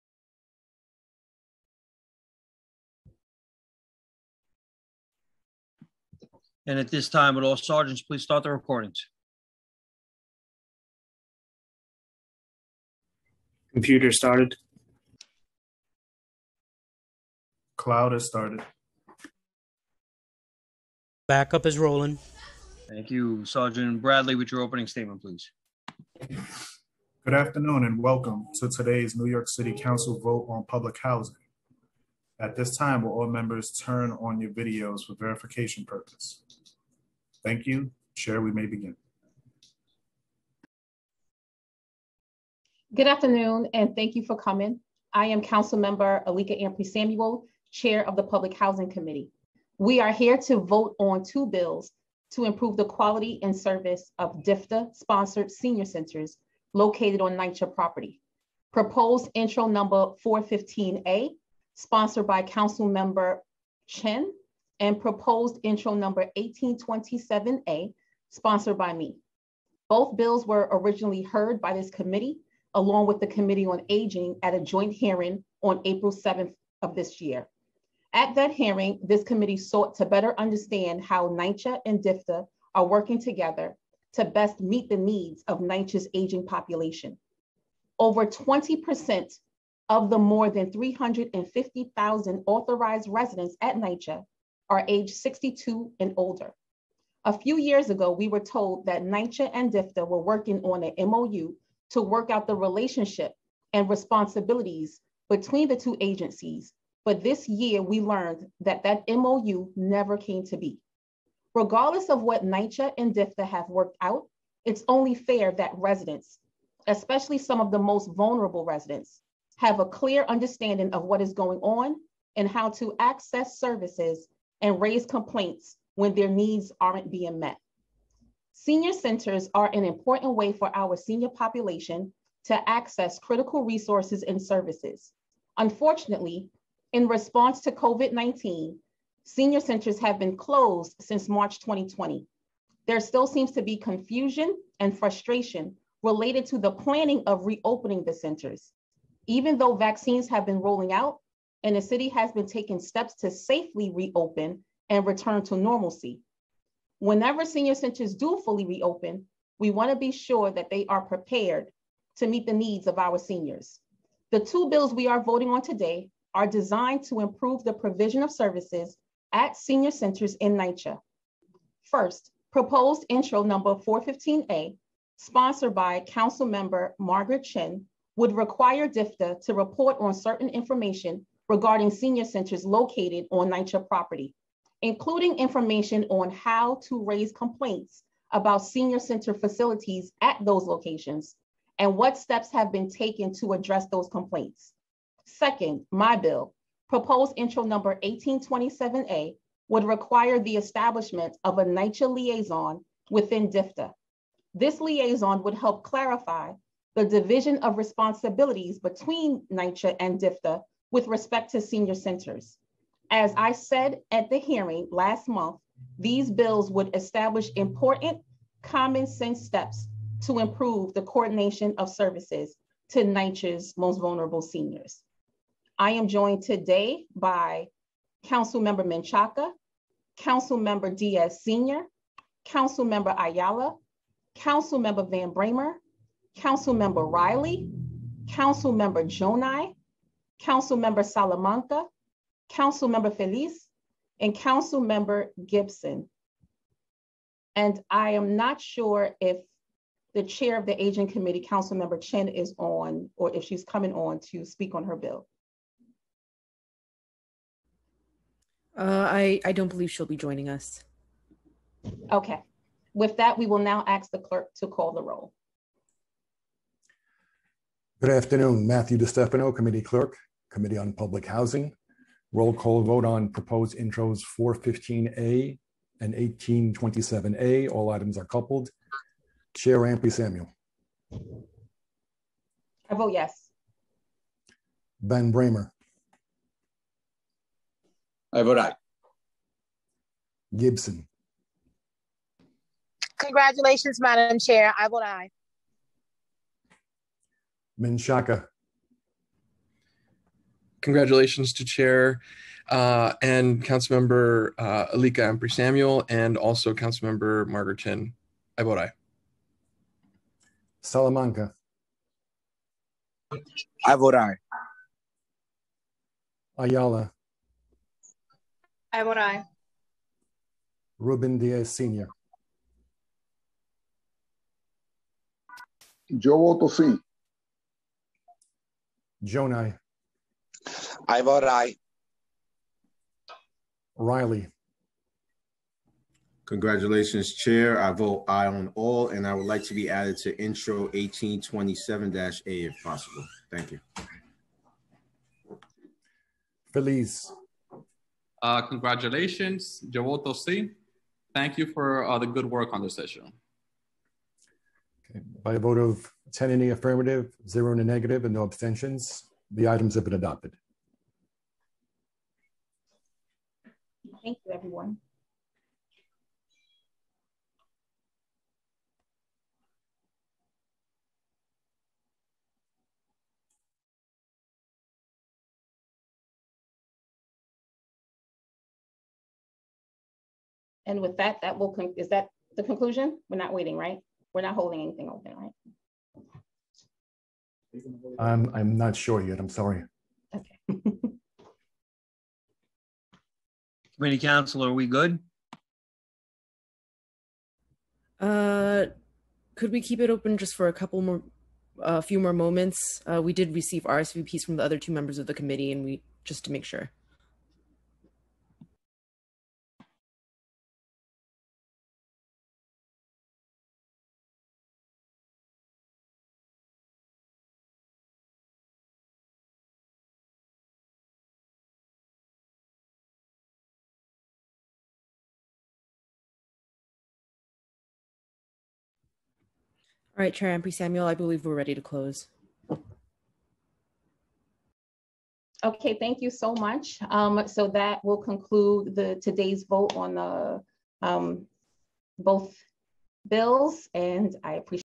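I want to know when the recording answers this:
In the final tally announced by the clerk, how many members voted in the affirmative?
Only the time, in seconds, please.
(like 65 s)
356 s.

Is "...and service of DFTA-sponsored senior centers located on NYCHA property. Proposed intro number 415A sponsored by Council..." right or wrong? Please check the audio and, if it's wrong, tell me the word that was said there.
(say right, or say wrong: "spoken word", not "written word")
right.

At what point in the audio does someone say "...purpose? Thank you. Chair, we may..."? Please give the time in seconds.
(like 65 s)
35 s.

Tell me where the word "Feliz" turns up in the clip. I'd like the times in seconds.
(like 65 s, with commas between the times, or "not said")
243 s, 346 s.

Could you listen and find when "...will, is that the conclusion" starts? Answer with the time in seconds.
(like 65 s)
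381 s.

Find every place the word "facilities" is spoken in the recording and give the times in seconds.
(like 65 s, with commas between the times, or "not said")
189 s.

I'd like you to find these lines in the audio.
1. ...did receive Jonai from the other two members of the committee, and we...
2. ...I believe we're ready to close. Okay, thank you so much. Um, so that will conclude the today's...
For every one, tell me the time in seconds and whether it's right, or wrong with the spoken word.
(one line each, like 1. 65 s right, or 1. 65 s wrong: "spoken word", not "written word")
1. 403 s wrong: "RSVPs", not "Jonai"
2. 431 s right.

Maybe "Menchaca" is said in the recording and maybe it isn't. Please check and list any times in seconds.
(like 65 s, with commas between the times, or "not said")
228 s, 297 s.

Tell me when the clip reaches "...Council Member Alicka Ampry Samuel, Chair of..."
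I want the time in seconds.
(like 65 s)
45 s.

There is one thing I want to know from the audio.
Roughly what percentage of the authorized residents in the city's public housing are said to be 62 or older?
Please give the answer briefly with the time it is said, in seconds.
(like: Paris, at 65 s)
20%, at 88 s.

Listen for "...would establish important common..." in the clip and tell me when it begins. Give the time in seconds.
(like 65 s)
216 s.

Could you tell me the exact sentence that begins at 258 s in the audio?
Uh, I, I don't believe she'll be joining us.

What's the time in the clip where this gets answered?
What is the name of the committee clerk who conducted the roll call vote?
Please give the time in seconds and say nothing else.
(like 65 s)
268 s.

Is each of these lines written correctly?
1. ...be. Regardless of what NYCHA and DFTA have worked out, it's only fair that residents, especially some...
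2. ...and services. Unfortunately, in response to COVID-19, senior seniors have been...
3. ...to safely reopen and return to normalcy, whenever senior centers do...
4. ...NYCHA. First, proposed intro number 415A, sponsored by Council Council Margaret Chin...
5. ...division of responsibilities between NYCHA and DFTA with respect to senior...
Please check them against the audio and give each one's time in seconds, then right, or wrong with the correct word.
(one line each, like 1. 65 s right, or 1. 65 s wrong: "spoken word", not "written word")
1. 110 s right
2. 134 s wrong: "centers", not "seniors"
3. 153 s right
4. 170 s wrong: "Member", not "Council"
5. 207 s right.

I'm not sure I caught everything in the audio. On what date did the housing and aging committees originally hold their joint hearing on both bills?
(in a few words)
April 7th.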